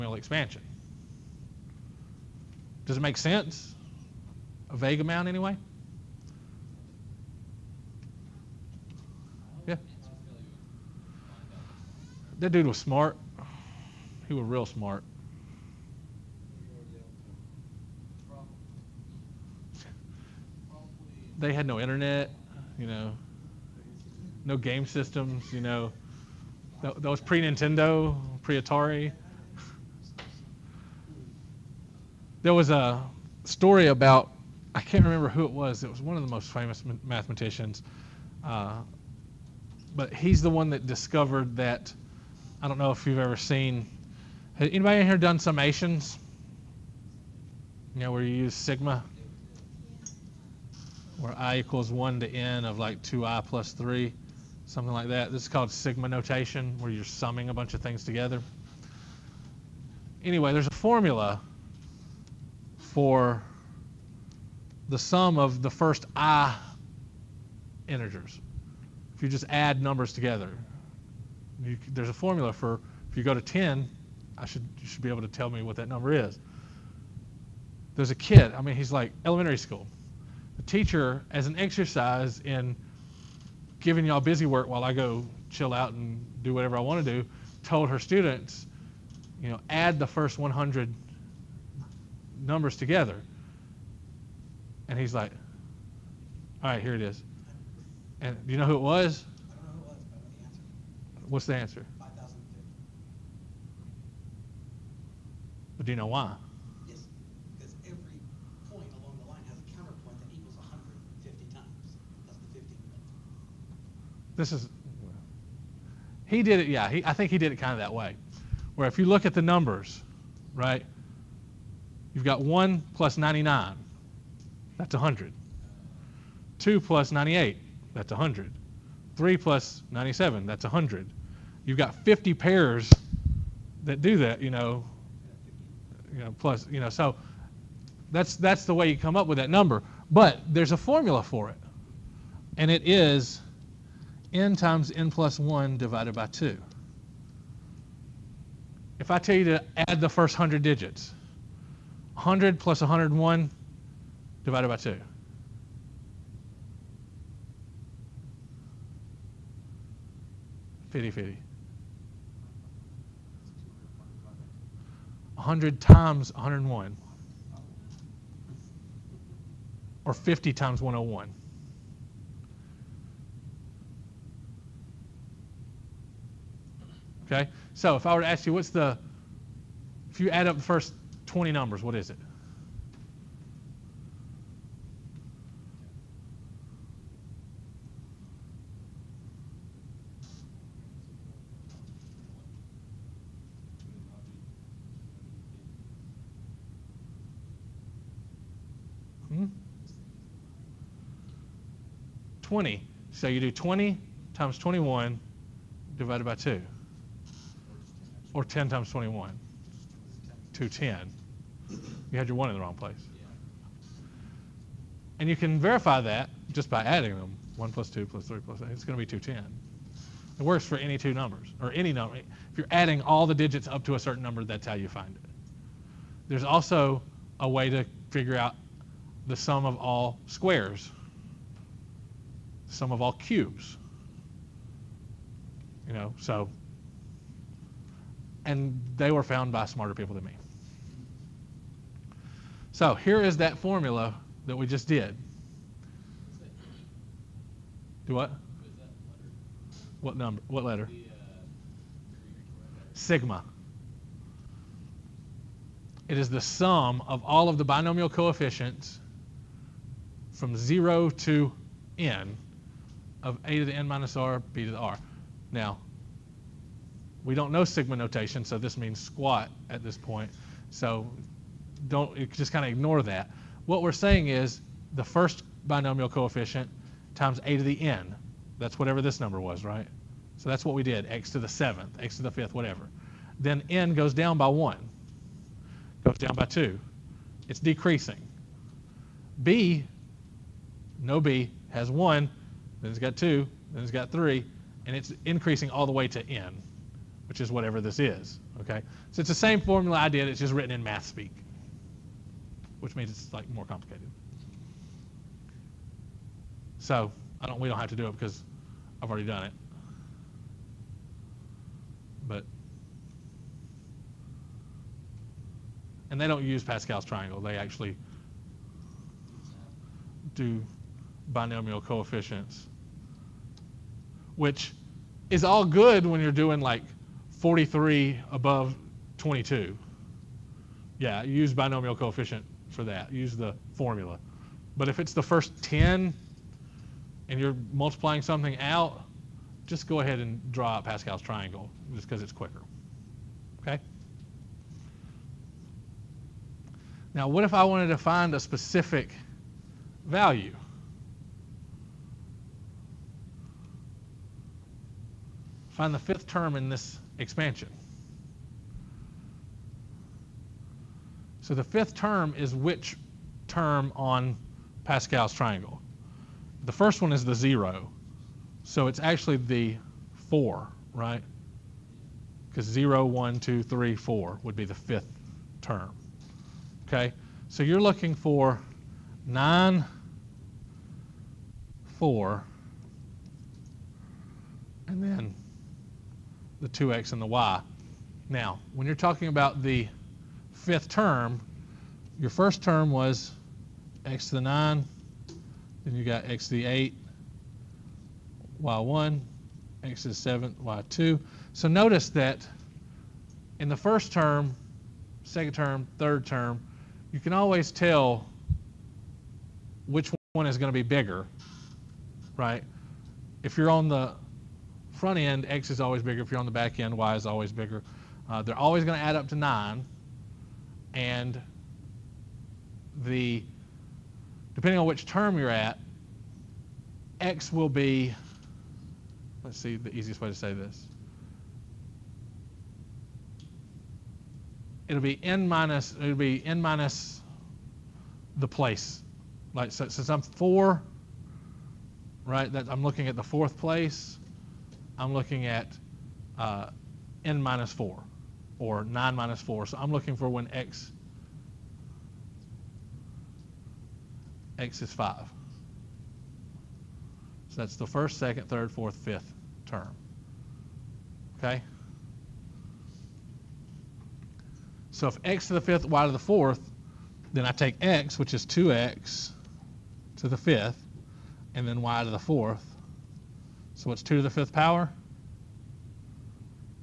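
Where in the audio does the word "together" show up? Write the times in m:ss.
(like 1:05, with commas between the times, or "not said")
0:58, 1:10, 1:32.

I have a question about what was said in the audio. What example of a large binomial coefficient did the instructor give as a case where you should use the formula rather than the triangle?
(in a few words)
43 above 22.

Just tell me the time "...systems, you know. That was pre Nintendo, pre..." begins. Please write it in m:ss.
0:24.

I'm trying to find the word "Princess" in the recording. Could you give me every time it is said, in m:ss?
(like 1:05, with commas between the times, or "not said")
not said.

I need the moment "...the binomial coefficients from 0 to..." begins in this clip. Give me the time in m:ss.
4:17.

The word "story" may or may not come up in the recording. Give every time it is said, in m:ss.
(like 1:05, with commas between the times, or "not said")
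0:33.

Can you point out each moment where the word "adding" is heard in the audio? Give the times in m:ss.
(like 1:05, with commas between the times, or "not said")
3:36, 3:42.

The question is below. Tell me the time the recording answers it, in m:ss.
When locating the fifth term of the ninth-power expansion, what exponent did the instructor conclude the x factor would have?
7:34.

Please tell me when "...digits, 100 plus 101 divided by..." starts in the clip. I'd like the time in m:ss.
2:30.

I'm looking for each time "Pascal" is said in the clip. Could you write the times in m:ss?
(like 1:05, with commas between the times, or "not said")
5:16, 5:40, 6:04.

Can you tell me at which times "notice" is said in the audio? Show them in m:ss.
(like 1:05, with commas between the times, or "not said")
6:41.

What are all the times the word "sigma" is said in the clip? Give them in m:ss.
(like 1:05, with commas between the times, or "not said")
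0:48, 0:55, 4:12, 4:27.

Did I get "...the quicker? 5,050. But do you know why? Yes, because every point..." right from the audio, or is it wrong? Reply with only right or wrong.
wrong.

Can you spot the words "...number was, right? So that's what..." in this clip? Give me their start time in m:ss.
4:39.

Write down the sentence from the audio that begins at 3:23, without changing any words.
So you do 20 times 21 divided by 2.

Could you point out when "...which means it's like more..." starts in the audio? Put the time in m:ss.
5:02.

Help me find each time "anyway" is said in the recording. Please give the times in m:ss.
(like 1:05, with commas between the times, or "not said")
0:05, 1:00.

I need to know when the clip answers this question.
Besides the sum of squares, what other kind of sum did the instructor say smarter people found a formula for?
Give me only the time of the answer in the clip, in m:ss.
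3:52.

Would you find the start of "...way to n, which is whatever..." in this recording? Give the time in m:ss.
4:55.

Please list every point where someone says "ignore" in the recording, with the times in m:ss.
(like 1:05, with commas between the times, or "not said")
4:32.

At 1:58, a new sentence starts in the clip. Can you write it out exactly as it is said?
Where if you look at the numbers, right, You've got 1 plus 99.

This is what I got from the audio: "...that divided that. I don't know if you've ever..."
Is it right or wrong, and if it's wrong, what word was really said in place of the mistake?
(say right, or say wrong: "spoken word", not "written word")
wrong: "discovered", not "divided".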